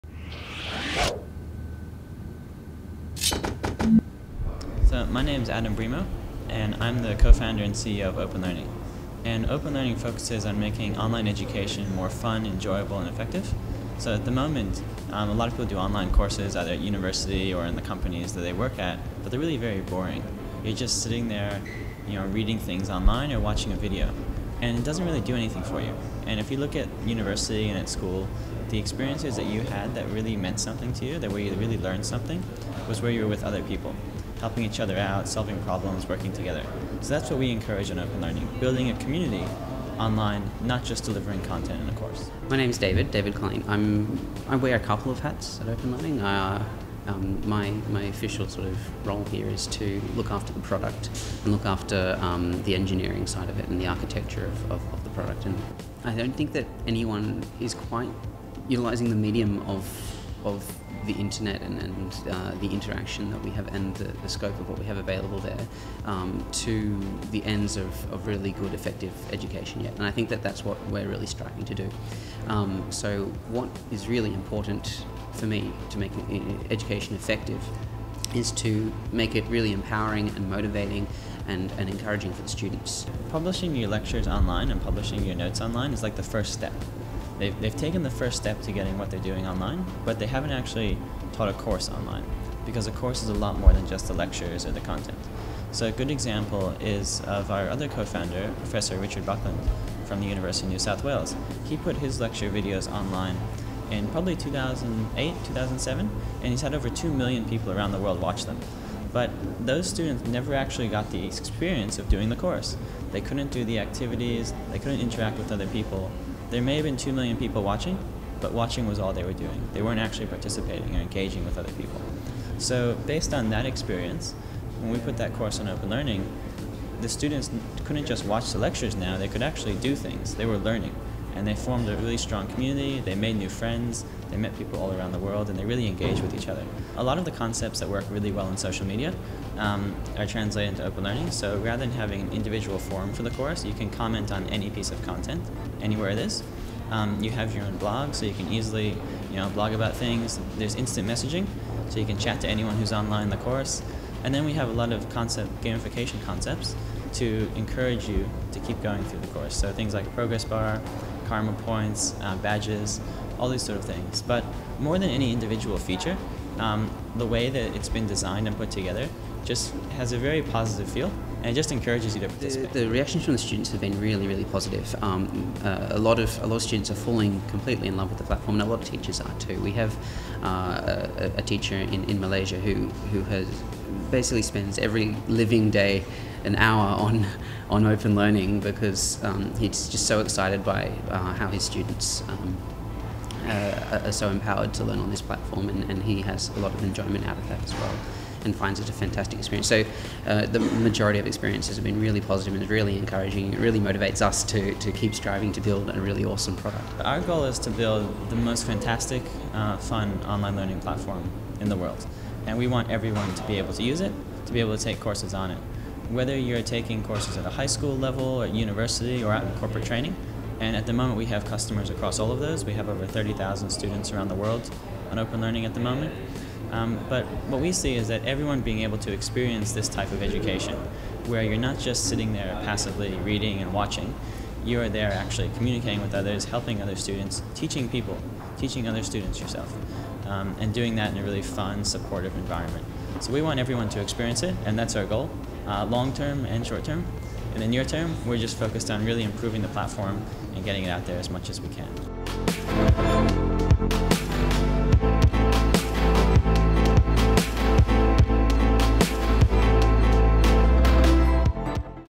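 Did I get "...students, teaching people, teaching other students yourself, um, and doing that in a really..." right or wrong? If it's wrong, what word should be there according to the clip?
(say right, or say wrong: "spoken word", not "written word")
right.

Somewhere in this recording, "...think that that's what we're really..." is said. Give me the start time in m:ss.
1:10.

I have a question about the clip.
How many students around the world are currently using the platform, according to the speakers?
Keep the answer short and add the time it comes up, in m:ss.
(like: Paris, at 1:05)
over 30,000, at 3:42.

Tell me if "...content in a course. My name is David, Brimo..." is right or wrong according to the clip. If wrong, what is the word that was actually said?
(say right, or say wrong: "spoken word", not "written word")
wrong: "David", not "Brimo".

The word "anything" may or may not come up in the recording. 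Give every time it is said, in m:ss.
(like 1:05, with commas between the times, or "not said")
0:25.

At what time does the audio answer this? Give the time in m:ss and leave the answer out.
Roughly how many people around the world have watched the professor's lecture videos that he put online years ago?
1:46.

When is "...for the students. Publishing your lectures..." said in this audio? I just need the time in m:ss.
1:22.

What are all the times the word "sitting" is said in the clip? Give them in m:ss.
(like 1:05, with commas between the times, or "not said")
0:21, 3:52.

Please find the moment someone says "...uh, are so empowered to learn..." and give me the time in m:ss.
3:13.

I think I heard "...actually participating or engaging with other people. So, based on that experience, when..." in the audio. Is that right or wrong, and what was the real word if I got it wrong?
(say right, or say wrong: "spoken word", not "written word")
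right.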